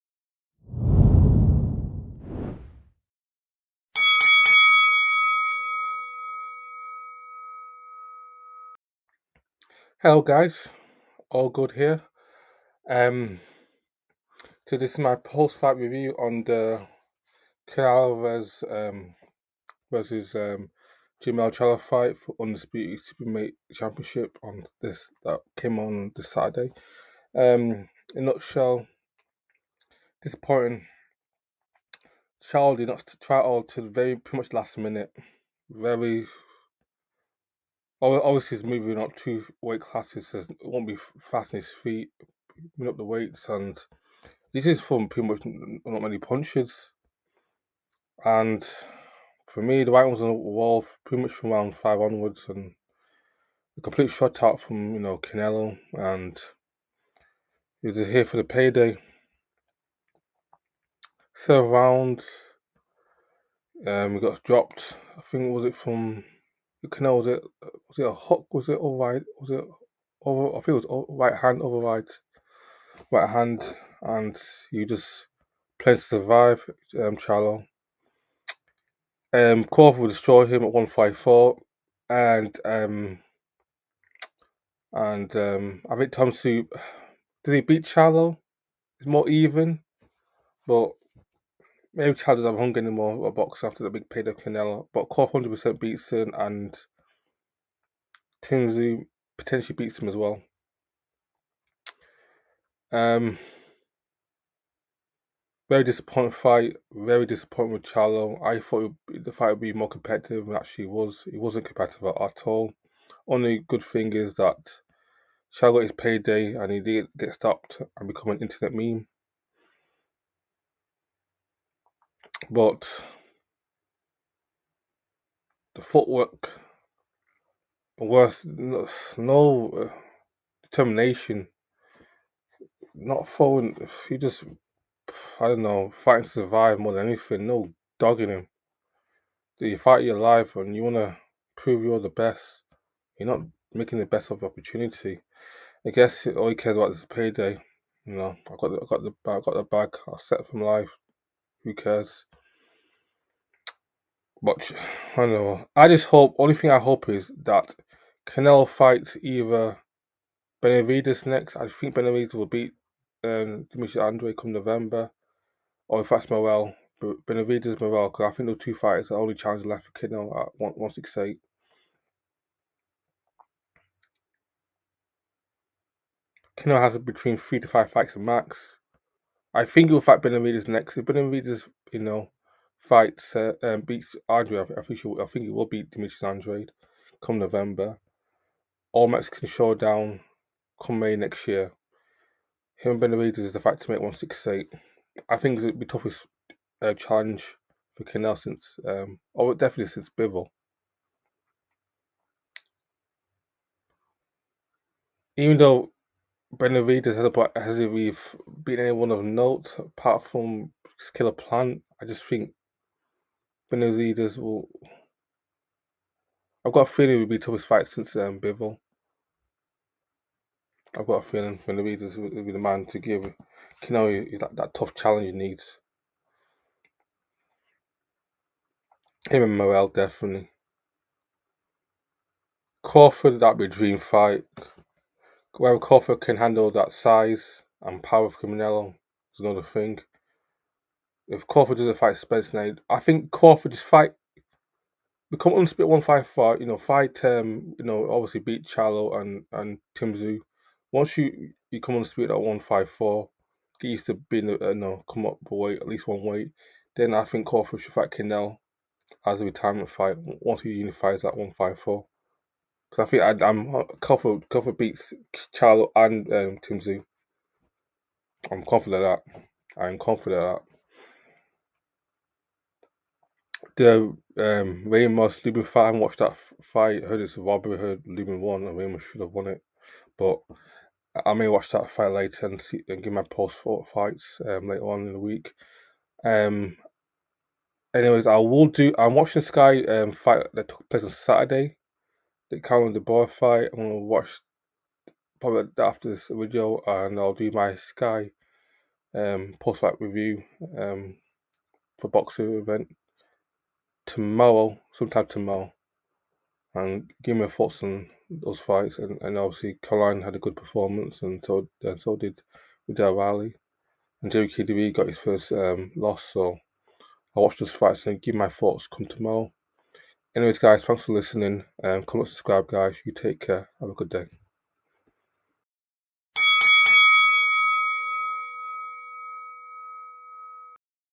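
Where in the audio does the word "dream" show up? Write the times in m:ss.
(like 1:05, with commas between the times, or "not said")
3:53.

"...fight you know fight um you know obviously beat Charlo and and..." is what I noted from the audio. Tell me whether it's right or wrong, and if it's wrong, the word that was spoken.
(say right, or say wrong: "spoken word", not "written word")
right.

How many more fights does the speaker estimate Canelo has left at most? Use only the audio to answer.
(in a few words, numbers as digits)
3 to 5.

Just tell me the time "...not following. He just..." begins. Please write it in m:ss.
2:12.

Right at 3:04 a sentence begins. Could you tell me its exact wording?
I, think she, I think he will beat Demetrius Andrade come November.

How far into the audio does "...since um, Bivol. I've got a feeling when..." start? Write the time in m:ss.
3:37.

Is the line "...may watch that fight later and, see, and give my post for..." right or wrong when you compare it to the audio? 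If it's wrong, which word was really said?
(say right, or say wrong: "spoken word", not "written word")
right.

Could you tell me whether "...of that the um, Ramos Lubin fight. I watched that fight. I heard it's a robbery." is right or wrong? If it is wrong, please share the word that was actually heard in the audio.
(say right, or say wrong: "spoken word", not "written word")
right.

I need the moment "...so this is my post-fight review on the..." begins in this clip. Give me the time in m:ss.
0:14.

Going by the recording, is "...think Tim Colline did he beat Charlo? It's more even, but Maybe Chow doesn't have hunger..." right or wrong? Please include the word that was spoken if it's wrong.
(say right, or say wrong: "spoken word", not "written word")
wrong: "Tszyu", not "Colline".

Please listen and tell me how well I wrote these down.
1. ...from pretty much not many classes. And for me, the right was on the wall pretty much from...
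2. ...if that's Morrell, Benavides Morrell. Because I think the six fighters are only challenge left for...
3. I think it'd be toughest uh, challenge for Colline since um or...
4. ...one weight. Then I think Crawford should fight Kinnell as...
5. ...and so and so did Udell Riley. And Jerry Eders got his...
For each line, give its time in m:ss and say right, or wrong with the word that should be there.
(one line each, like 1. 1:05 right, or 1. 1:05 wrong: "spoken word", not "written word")
1. 0:44 wrong: "punches", not "classes"
2. 2:46 wrong: "two", not "six"
3. 3:15 wrong: "Canel", not "Colline"
4. 4:16 right
5. 5:11 wrong: "KDB", not "Eders".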